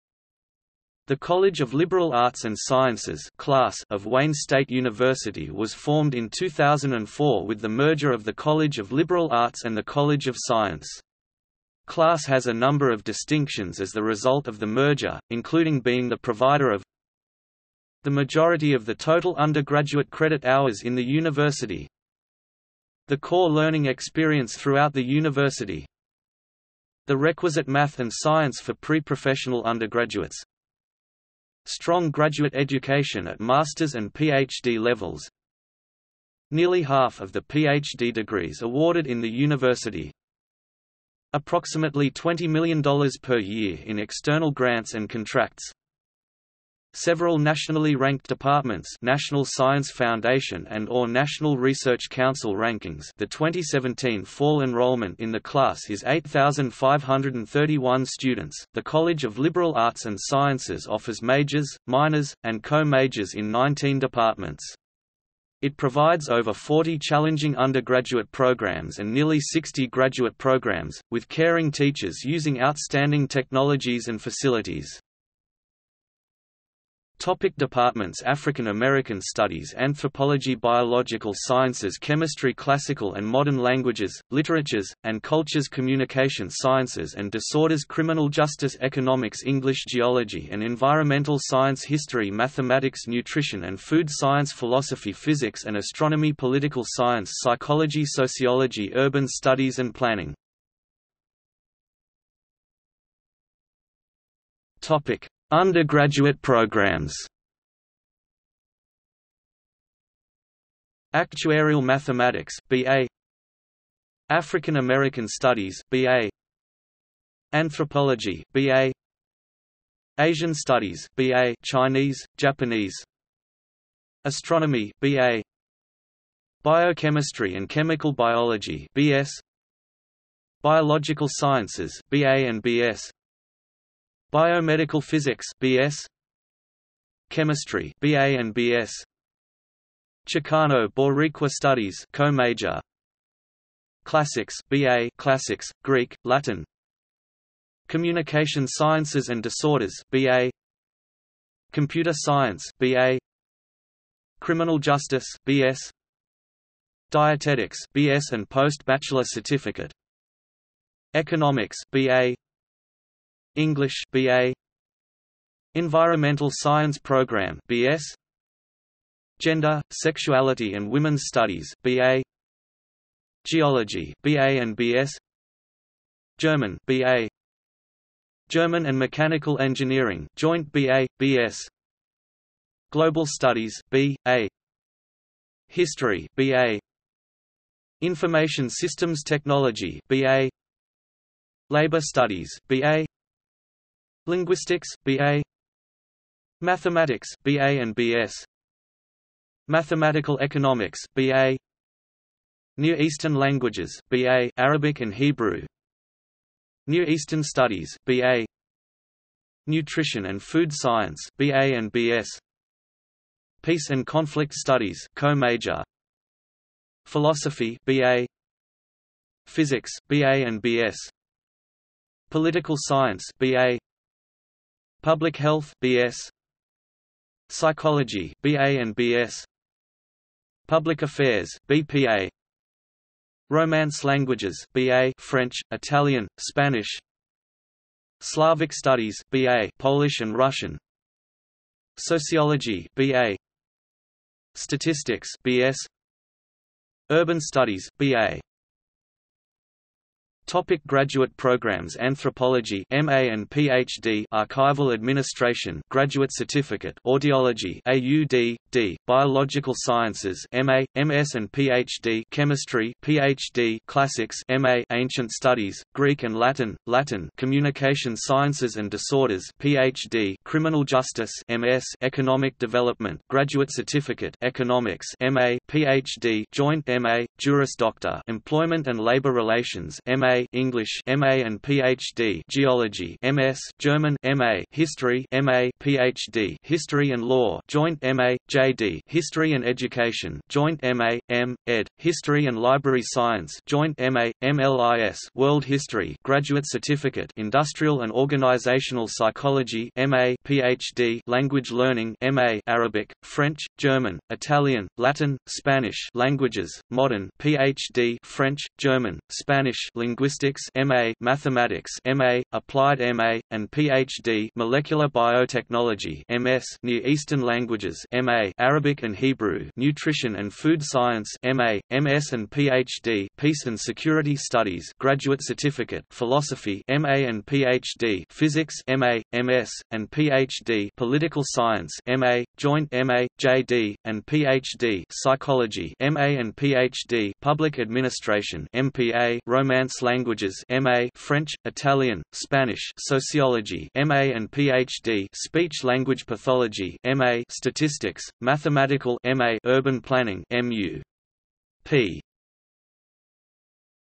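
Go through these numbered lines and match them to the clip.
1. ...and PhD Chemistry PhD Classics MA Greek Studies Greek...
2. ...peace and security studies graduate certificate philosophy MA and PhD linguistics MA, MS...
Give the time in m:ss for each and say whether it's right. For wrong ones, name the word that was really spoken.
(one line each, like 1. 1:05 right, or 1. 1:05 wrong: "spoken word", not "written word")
1. 4:21 wrong: "Ancient", not "Greek"
2. 5:23 wrong: "physics", not "linguistics".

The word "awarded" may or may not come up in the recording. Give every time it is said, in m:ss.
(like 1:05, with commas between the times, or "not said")
0:38.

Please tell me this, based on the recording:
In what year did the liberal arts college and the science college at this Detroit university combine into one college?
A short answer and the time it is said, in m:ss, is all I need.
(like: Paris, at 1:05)
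2004, at 0:06.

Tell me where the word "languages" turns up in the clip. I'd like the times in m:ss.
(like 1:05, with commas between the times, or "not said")
1:23, 3:23, 3:54, 5:01, 5:06, 5:17, 5:40, 5:45.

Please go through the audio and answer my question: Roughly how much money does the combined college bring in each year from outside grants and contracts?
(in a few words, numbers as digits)
$20 million.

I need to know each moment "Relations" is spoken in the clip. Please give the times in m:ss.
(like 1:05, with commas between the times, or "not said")
4:39.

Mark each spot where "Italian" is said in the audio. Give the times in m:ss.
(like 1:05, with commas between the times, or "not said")
3:55, 5:04, 5:41.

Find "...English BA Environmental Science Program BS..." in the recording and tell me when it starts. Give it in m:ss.
2:43.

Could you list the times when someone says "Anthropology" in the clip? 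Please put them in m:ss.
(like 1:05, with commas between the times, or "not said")
1:19, 1:57, 4:11.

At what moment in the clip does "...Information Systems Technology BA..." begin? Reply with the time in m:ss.
3:07.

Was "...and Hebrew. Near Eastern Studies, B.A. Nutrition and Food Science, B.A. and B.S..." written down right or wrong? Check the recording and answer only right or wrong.
right.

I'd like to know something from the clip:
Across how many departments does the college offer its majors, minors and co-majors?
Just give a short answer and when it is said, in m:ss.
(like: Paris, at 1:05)
19, at 1:03.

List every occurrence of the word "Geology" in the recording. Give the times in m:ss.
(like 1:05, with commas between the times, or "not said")
1:29, 2:53, 4:42.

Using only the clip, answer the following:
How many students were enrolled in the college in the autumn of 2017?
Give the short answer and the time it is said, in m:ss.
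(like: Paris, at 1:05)
8,531, at 0:56.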